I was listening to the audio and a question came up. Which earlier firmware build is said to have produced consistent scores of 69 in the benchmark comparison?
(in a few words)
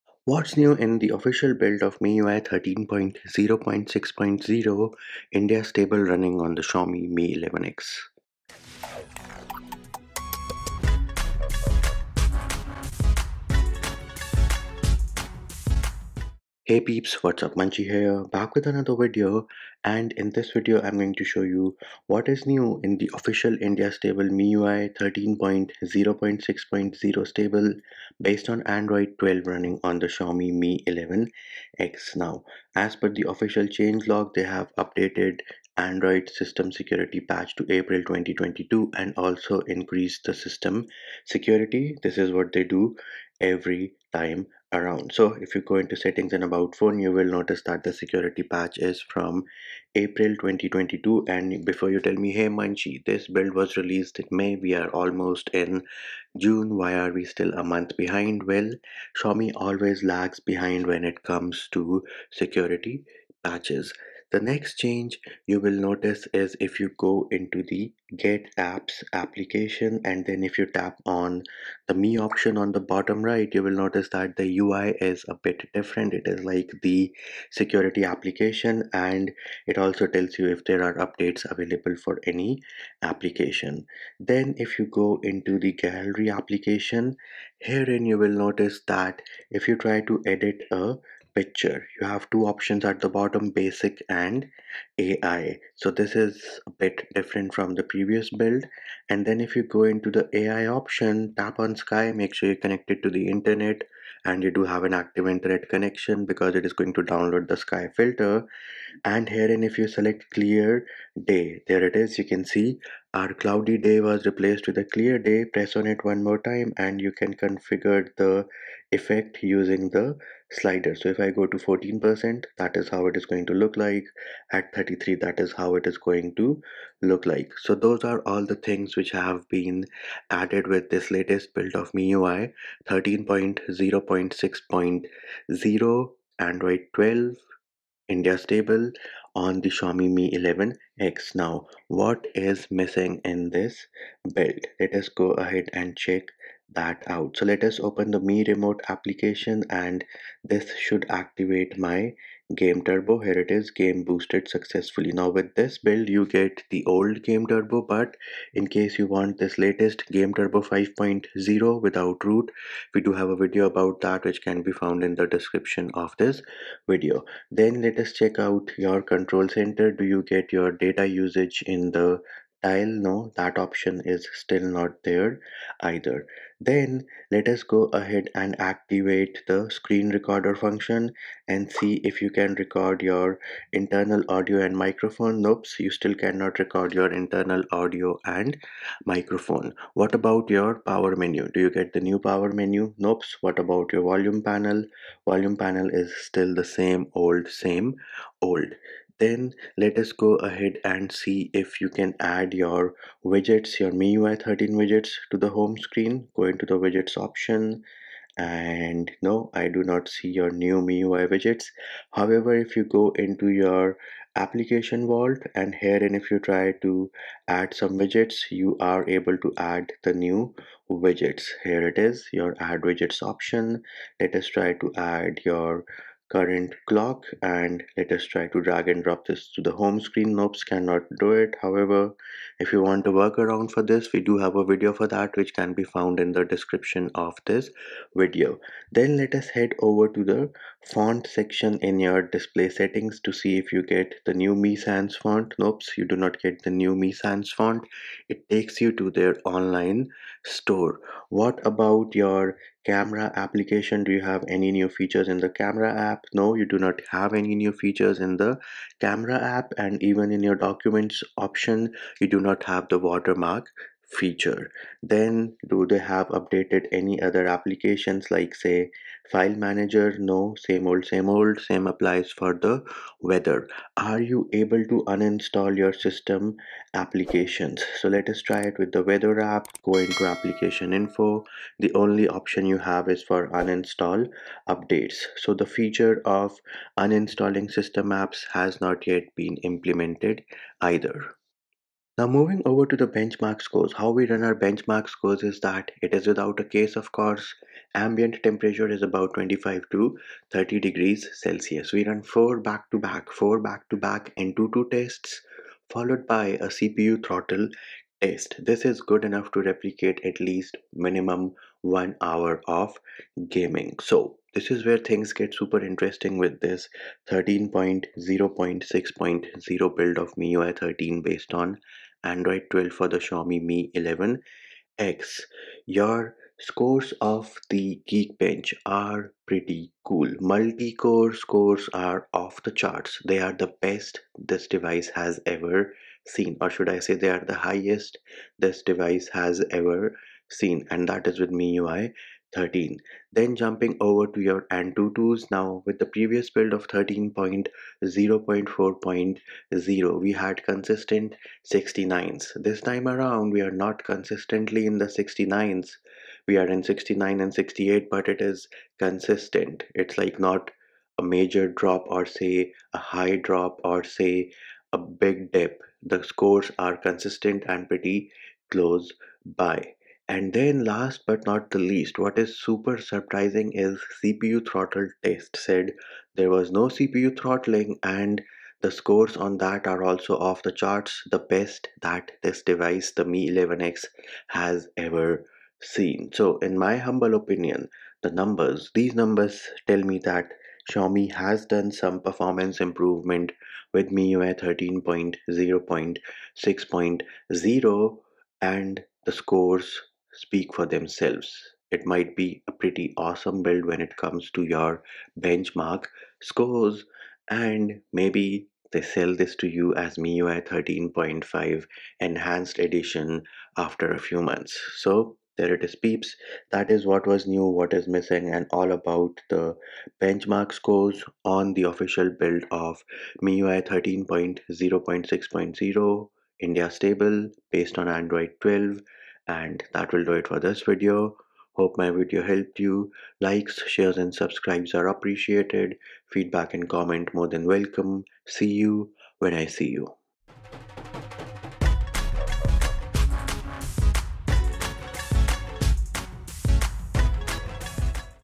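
13.0.4.0.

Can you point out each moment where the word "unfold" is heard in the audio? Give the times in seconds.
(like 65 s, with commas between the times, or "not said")
not said.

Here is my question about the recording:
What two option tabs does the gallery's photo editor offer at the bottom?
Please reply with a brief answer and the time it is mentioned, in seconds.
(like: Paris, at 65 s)
Basic and AI, at 93 s.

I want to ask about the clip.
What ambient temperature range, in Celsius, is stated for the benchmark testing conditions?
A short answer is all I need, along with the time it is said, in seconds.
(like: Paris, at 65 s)
25 to 30 degrees, at 299 s.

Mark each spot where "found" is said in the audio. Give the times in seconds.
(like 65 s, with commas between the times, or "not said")
164 s, 235 s.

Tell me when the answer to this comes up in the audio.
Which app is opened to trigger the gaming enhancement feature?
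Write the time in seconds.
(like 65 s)
148 s.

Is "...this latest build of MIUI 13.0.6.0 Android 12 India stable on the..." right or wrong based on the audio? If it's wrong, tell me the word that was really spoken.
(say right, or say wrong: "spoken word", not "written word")
right.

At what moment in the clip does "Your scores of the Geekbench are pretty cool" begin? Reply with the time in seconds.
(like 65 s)
325 s.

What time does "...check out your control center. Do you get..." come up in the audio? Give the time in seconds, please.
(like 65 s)
168 s.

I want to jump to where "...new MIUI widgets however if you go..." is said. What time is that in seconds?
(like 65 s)
210 s.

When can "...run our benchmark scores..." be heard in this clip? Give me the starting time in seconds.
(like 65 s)
294 s.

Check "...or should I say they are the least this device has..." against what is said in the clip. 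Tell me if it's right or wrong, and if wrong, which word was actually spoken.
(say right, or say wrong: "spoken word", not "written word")
wrong: "highest", not "least".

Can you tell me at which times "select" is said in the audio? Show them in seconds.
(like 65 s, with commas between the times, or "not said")
109 s.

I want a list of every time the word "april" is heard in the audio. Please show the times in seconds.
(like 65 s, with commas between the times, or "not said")
37 s, 49 s.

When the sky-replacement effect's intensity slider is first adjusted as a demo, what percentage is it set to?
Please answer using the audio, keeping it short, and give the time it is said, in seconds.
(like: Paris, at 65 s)
14%, at 121 s.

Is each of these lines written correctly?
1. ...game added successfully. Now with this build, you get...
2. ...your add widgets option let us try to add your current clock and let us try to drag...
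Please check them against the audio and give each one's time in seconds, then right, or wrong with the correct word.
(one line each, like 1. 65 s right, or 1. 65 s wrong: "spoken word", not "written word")
1. 153 s wrong: "boosted", not "added"
2. 222 s right.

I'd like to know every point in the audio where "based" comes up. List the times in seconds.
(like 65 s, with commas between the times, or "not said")
28 s, 321 s, 427 s.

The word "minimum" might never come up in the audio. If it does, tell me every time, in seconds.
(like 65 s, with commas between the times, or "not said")
310 s.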